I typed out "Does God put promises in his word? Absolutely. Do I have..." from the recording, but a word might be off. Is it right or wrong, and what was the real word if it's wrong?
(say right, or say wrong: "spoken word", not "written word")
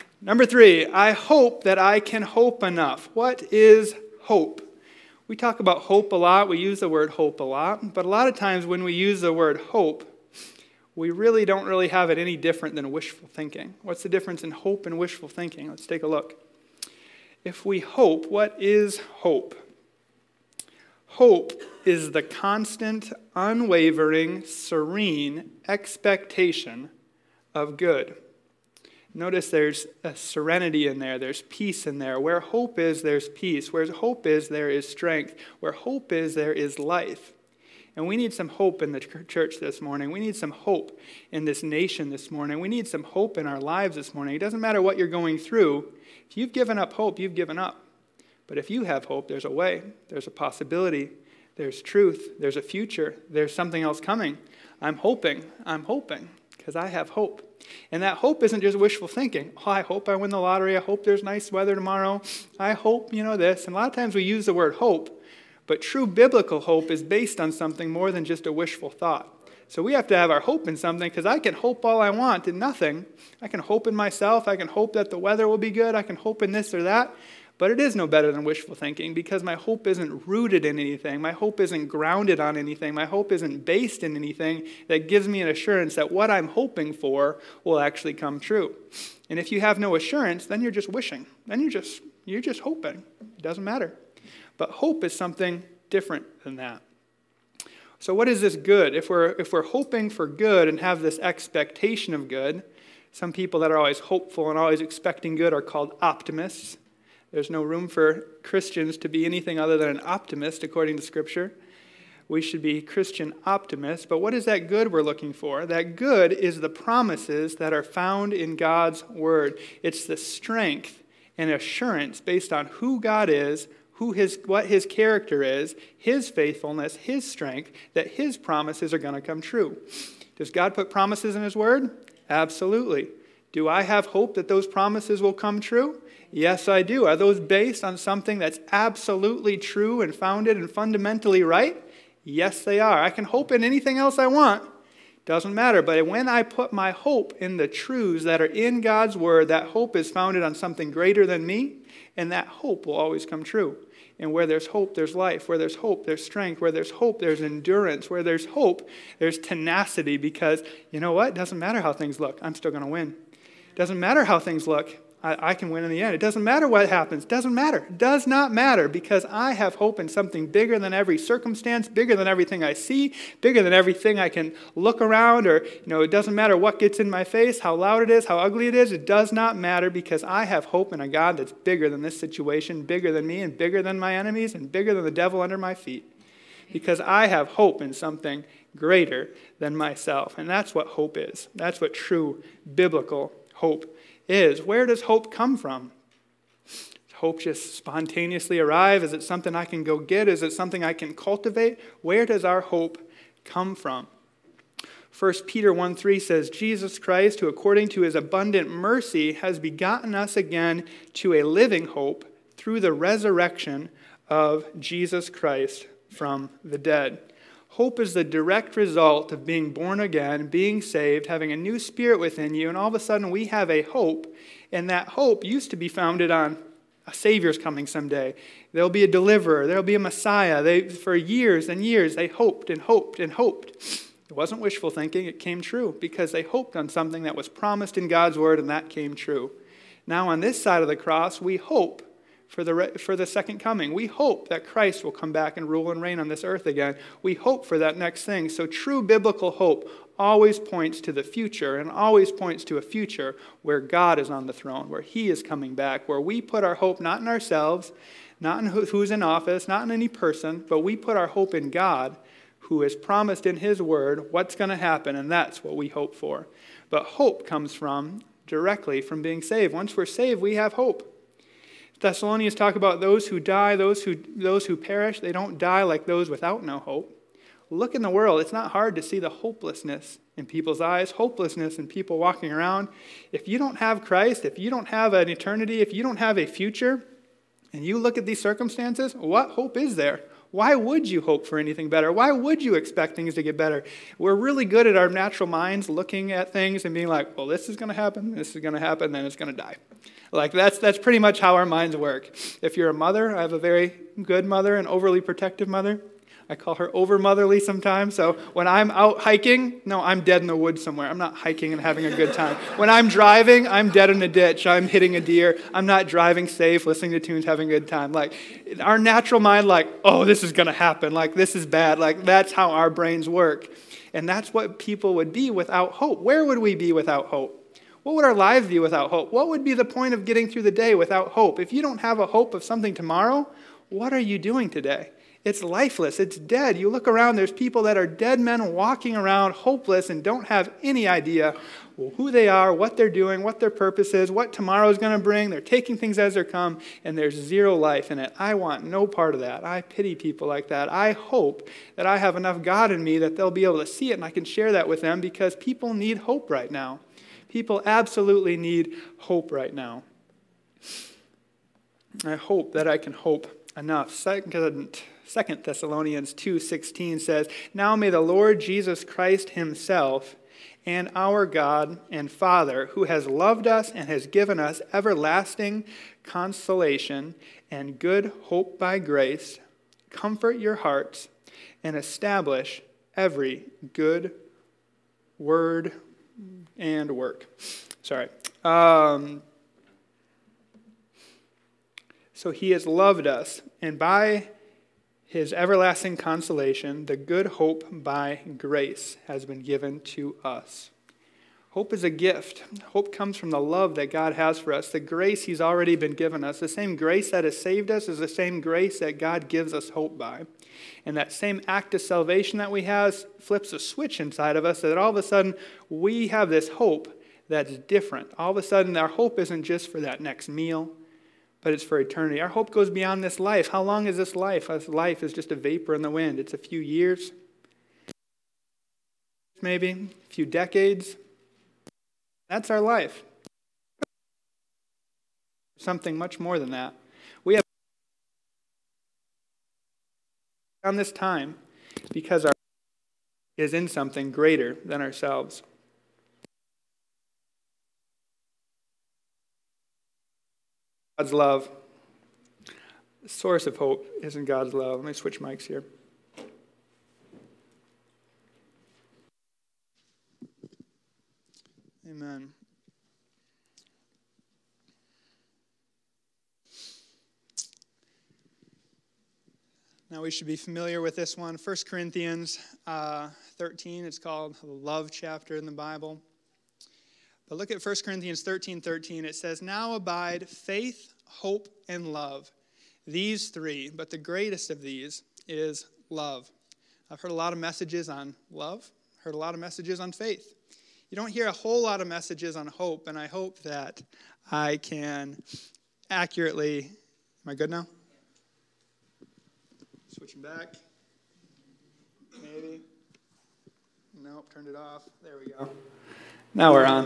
right.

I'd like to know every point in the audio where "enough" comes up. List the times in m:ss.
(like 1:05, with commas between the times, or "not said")
0:02, 5:52, 6:03.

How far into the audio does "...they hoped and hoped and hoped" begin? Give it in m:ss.
3:52.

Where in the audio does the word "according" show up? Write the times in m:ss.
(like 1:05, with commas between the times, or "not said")
1:50, 3:27.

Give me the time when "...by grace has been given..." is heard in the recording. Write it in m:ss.
6:37.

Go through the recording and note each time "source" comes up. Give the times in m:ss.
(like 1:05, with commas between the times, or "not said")
7:33.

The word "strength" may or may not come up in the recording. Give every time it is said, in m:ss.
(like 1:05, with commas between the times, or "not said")
0:34, 2:00, 2:07, 2:36.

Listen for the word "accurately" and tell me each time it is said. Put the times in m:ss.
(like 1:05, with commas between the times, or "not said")
8:16.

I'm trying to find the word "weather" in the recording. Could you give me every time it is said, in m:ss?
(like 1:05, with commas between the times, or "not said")
1:01, 1:15.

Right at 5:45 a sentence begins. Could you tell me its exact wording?
They're taking things as they come, and there's zero life in it.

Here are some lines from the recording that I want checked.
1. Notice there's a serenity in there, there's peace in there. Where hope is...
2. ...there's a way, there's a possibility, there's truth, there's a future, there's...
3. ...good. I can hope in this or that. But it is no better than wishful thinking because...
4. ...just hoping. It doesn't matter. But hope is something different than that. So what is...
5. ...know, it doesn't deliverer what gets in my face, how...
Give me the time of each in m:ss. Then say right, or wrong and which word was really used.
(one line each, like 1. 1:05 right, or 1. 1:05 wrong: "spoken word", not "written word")
1. 0:29 right
2. 0:49 right
3. 1:15 right
4. 1:32 right
5. 2:55 wrong: "matter", not "deliverer".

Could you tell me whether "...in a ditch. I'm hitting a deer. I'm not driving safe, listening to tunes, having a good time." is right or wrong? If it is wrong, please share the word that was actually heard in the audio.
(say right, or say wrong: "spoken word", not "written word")
right.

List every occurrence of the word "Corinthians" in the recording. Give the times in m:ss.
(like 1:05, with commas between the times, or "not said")
7:51, 7:58.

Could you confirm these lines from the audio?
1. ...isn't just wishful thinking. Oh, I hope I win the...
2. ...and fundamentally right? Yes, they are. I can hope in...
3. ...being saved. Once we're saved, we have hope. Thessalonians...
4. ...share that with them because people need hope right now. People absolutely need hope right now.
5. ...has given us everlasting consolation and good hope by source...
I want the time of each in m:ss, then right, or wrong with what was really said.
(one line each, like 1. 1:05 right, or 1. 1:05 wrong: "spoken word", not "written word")
1. 0:58 right
2. 2:20 right
3. 4:29 right
4. 5:54 right
5. 6:14 wrong: "grace", not "source".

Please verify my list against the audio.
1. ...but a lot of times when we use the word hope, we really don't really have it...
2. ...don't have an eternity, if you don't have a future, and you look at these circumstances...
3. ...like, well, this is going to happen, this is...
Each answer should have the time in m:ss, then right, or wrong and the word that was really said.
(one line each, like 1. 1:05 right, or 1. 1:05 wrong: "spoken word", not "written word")
1. 0:07 right
2. 4:44 right
3. 4:57 right.